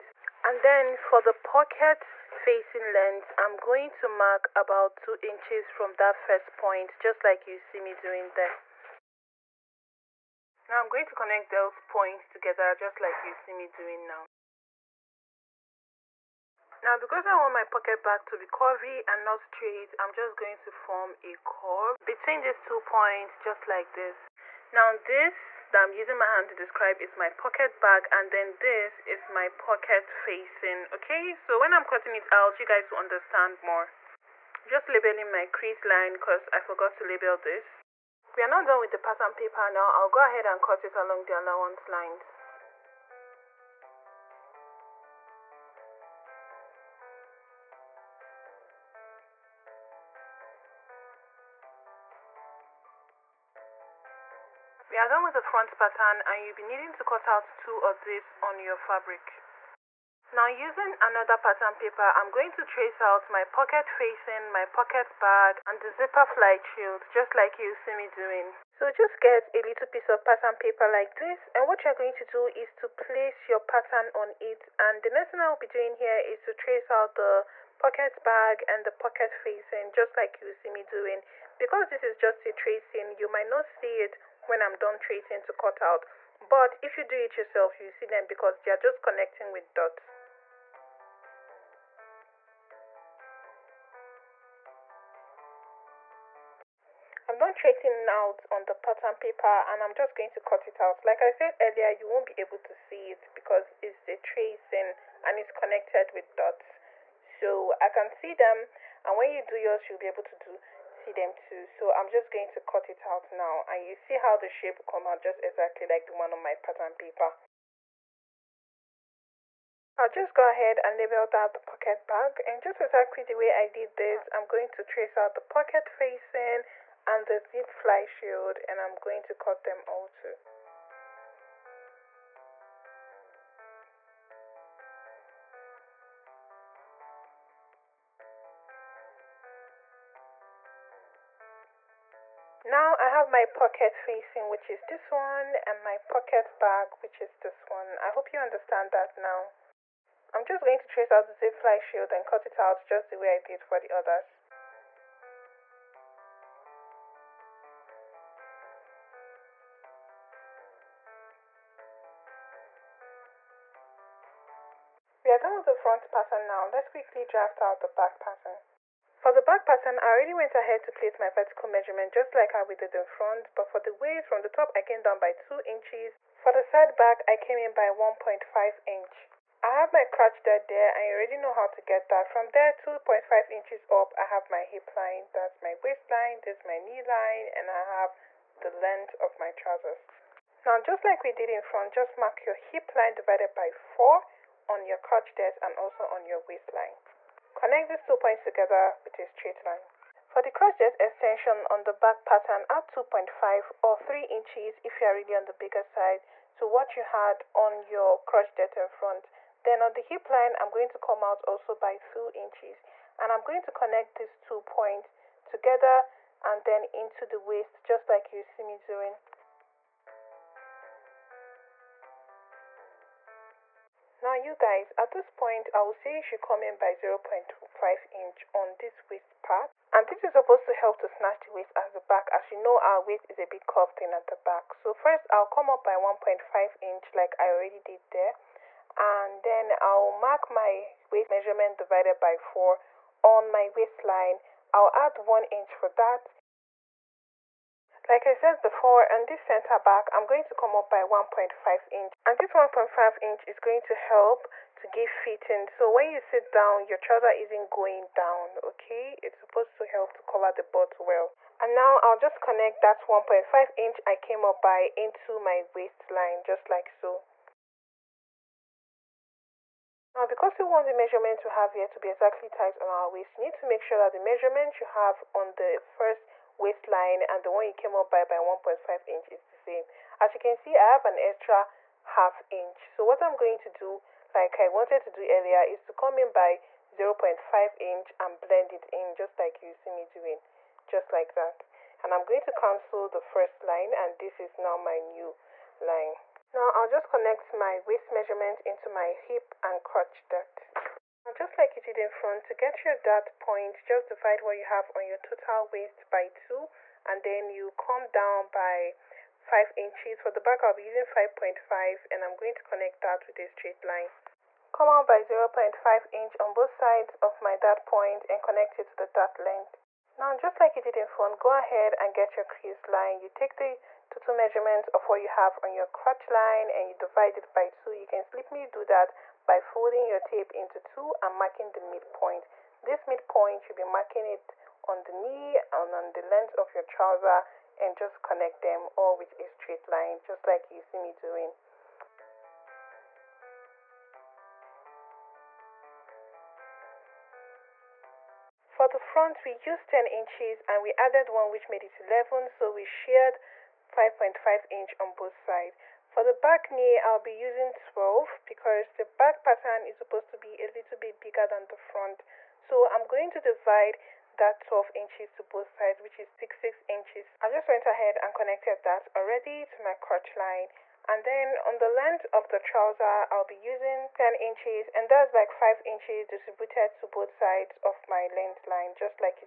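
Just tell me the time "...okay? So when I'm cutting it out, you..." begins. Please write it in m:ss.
0:30.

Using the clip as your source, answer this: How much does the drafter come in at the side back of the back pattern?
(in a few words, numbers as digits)
1.5 inch.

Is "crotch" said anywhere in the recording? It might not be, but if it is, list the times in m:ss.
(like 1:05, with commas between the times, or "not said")
3:00, 3:14, 4:59, 5:25, 6:09.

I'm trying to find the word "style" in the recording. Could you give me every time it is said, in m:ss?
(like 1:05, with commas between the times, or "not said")
not said.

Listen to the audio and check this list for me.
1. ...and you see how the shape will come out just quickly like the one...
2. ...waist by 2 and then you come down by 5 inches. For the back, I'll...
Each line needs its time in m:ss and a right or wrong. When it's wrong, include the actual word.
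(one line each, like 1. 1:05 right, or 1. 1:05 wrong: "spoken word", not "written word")
1. 1:53 wrong: "exactly", not "quickly"
2. 5:05 right.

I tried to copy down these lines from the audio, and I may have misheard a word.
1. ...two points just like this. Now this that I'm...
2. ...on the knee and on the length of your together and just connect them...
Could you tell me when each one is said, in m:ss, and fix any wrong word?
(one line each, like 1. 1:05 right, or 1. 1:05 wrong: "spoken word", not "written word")
1. 0:22 right
2. 5:34 wrong: "trouser", not "together".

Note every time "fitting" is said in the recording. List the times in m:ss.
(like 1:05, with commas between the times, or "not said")
4:15.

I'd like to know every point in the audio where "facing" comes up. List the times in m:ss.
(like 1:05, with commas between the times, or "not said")
0:02, 0:30, 1:03, 1:19, 2:05, 2:23.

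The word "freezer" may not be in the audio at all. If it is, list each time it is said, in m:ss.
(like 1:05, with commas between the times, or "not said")
not said.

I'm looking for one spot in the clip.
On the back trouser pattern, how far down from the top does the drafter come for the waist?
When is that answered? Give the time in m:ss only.
2:54.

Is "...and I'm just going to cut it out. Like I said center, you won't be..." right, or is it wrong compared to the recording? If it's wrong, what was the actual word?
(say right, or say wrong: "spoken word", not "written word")
wrong: "earlier", not "center".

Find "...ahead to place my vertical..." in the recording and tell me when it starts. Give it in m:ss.
2:50.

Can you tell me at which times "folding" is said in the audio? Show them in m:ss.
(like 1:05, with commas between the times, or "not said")
5:29.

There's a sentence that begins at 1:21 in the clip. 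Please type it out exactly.
Because this is just a tracing, you might not see it when I'm done tracing to cut out.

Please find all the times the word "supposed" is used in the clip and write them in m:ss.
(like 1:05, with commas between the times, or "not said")
3:50, 4:19, 5:59.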